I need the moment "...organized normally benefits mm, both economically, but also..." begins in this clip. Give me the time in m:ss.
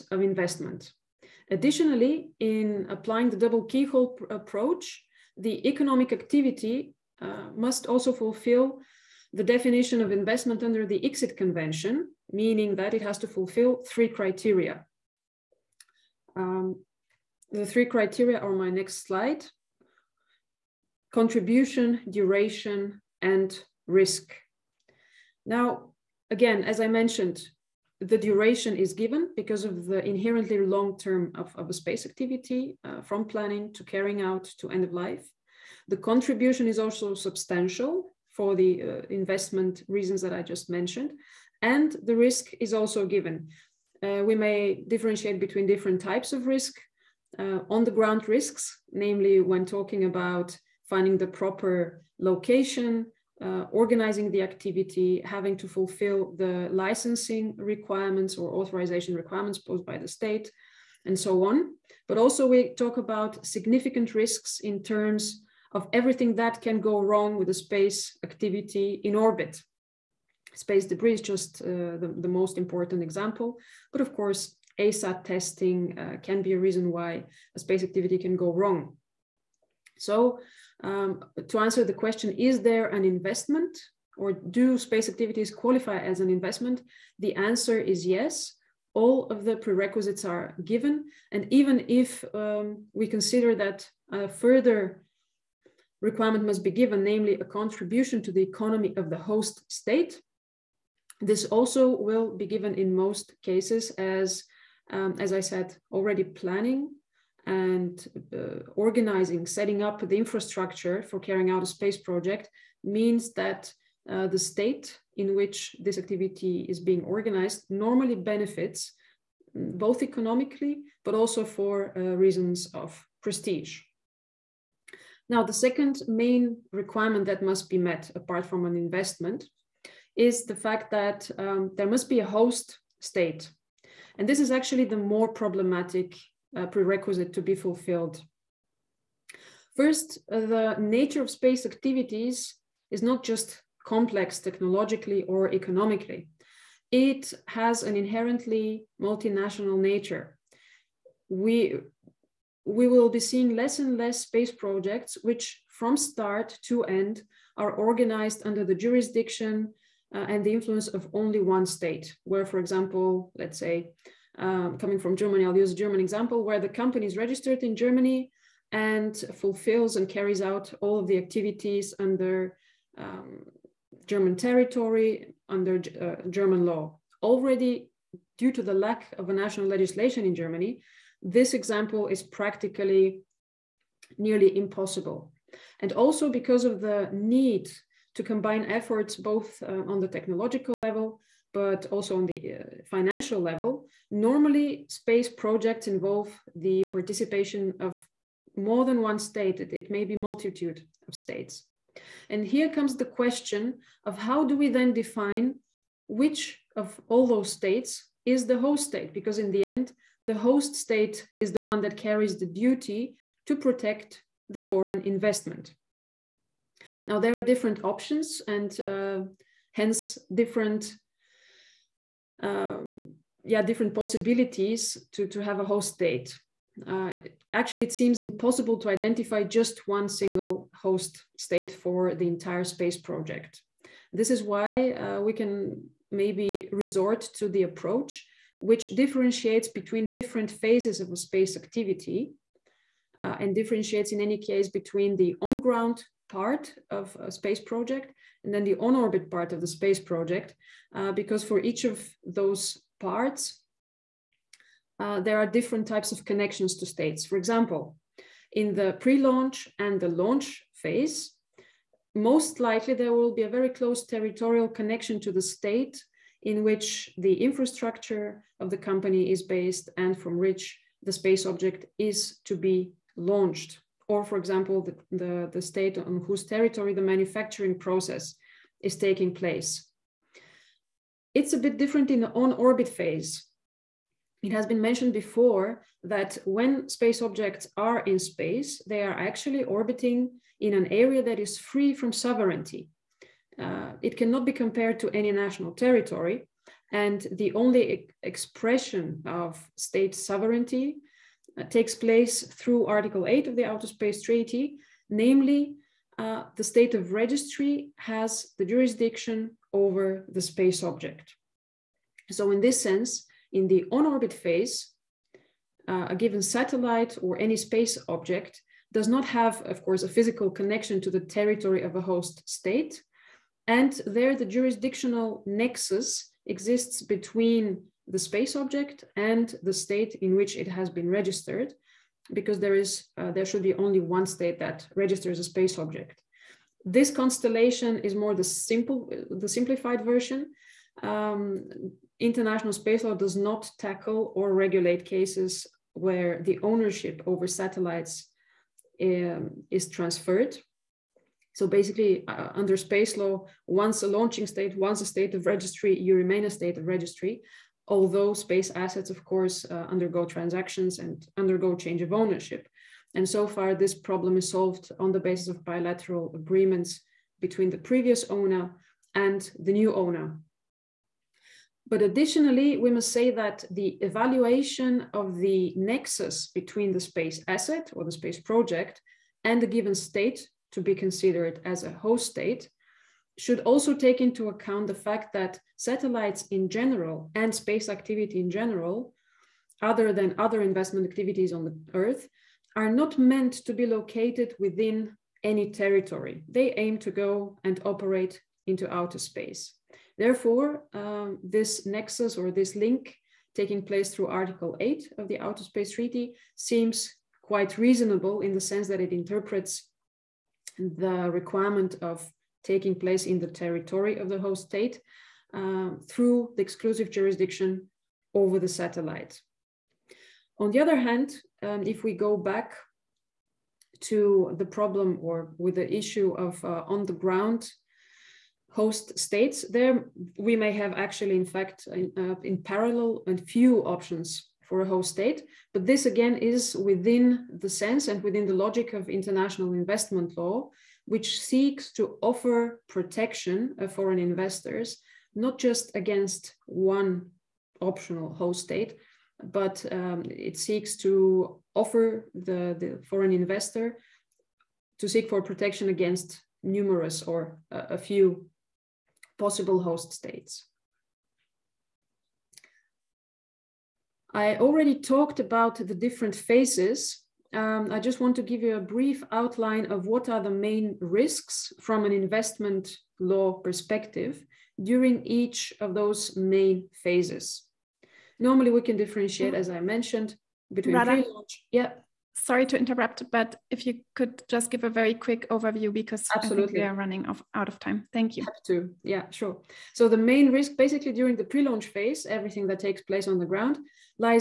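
1:57.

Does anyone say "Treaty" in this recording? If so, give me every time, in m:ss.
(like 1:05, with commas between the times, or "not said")
5:04, 6:45.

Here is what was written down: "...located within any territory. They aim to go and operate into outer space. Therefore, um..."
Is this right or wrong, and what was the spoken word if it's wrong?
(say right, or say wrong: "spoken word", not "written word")
right.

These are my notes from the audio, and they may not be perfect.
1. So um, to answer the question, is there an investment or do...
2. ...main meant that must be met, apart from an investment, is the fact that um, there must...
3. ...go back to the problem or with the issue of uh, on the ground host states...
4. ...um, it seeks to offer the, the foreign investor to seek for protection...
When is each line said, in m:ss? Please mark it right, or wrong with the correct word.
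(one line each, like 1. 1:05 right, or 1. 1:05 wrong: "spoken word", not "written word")
1. 1:19 right
2. 2:06 wrong: "requirement", not "meant"
3. 7:02 right
4. 7:29 right.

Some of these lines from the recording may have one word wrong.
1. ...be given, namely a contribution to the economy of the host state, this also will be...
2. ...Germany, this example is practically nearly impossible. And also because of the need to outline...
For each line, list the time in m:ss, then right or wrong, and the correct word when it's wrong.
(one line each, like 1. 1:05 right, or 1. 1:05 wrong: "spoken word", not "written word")
1. 1:36 right
2. 3:00 wrong: "combine", not "outline".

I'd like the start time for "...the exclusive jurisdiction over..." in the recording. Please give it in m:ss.
6:56.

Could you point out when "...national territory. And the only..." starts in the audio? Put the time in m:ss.
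4:55.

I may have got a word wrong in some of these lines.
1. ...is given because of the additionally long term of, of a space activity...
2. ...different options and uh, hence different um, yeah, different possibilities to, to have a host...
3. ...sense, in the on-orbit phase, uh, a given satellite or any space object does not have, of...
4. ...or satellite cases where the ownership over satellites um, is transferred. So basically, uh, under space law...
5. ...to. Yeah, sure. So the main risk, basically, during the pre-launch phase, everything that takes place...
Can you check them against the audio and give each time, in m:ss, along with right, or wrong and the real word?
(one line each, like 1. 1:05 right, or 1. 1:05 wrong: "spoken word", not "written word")
1. 0:28 wrong: "inherently", not "additionally"
2. 3:37 right
3. 5:12 right
4. 5:44 wrong: "regulate", not "satellite"
5. 8:08 right.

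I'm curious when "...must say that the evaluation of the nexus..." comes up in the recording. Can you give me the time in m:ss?
6:12.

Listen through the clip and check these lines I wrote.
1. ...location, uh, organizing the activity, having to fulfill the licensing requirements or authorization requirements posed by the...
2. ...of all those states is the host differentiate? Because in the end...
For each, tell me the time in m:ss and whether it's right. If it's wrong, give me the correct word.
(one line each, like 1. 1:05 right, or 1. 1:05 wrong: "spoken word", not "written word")
1. 0:52 right
2. 3:26 wrong: "state", not "differentiate".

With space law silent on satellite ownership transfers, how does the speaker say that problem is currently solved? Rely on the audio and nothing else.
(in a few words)
Bilateral agreements.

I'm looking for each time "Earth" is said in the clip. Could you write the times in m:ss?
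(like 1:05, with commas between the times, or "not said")
6:31.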